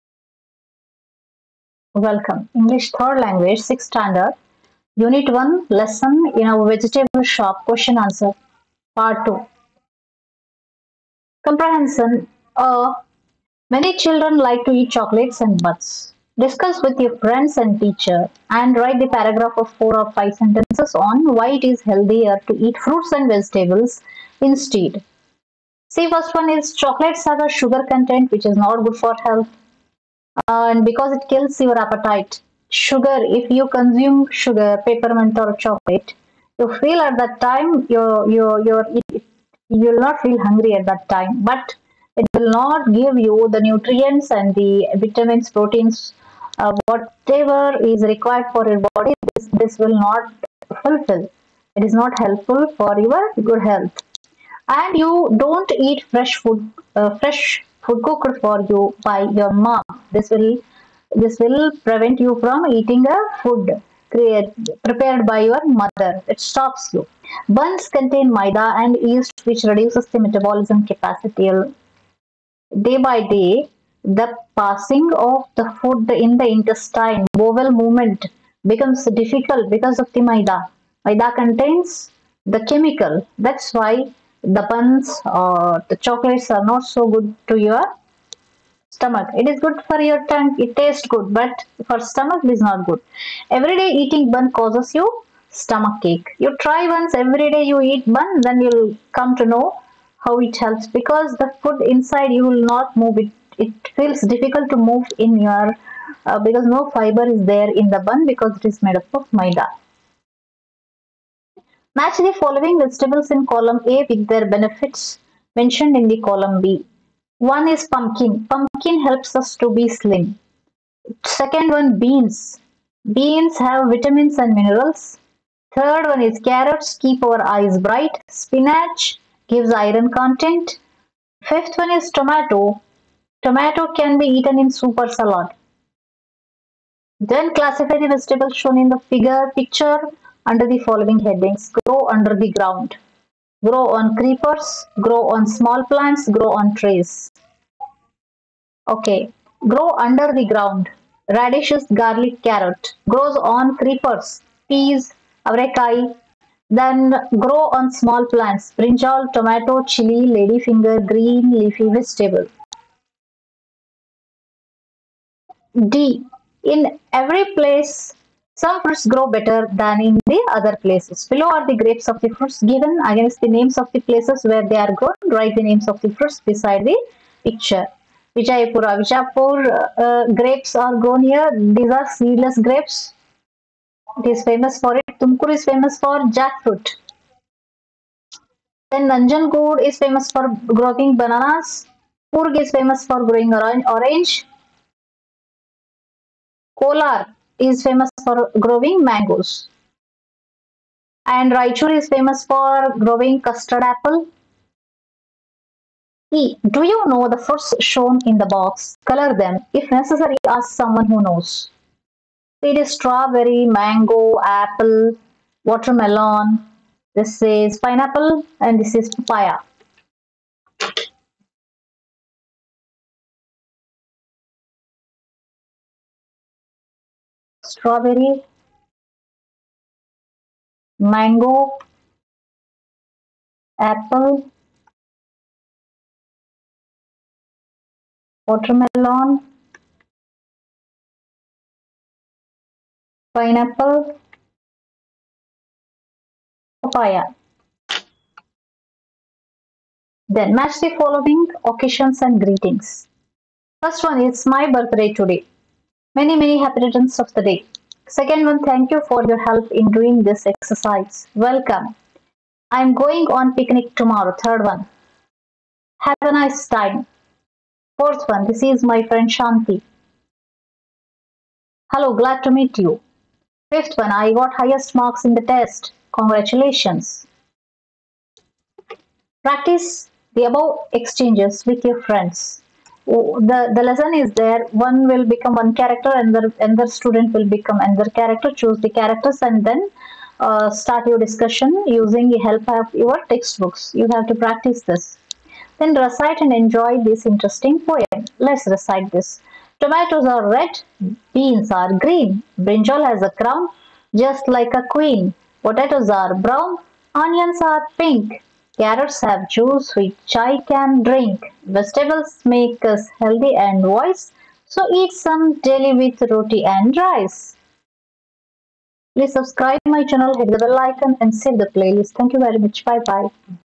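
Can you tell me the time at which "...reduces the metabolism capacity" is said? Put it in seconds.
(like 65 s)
69 s.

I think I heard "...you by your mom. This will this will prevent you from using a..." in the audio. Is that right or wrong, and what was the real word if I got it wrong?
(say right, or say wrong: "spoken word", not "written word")
wrong: "eating", not "using".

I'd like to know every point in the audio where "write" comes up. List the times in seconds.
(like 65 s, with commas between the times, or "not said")
18 s, 175 s.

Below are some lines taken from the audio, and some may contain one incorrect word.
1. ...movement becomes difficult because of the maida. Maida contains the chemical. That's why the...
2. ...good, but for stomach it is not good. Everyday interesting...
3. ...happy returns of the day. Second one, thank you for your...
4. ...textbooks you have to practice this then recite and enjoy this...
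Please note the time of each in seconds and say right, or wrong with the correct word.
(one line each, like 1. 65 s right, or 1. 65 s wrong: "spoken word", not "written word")
1. 77 s right
2. 91 s wrong: "eating", not "interesting"
3. 256 s right
4. 293 s right.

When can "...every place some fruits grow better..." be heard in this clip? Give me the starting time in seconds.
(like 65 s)
167 s.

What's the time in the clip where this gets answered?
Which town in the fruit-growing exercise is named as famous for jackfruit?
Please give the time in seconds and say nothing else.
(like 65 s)
185 s.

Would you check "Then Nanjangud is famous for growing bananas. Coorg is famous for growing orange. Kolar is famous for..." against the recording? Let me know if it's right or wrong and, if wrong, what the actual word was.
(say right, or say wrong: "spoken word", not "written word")
right.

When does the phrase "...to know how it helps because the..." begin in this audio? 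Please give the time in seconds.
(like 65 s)
99 s.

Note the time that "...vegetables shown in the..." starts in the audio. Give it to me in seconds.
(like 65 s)
138 s.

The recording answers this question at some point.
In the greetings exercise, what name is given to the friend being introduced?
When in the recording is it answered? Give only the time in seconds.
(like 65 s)
269 s.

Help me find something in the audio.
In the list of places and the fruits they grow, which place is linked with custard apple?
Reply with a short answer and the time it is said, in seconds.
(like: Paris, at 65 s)
Raichur, at 201 s.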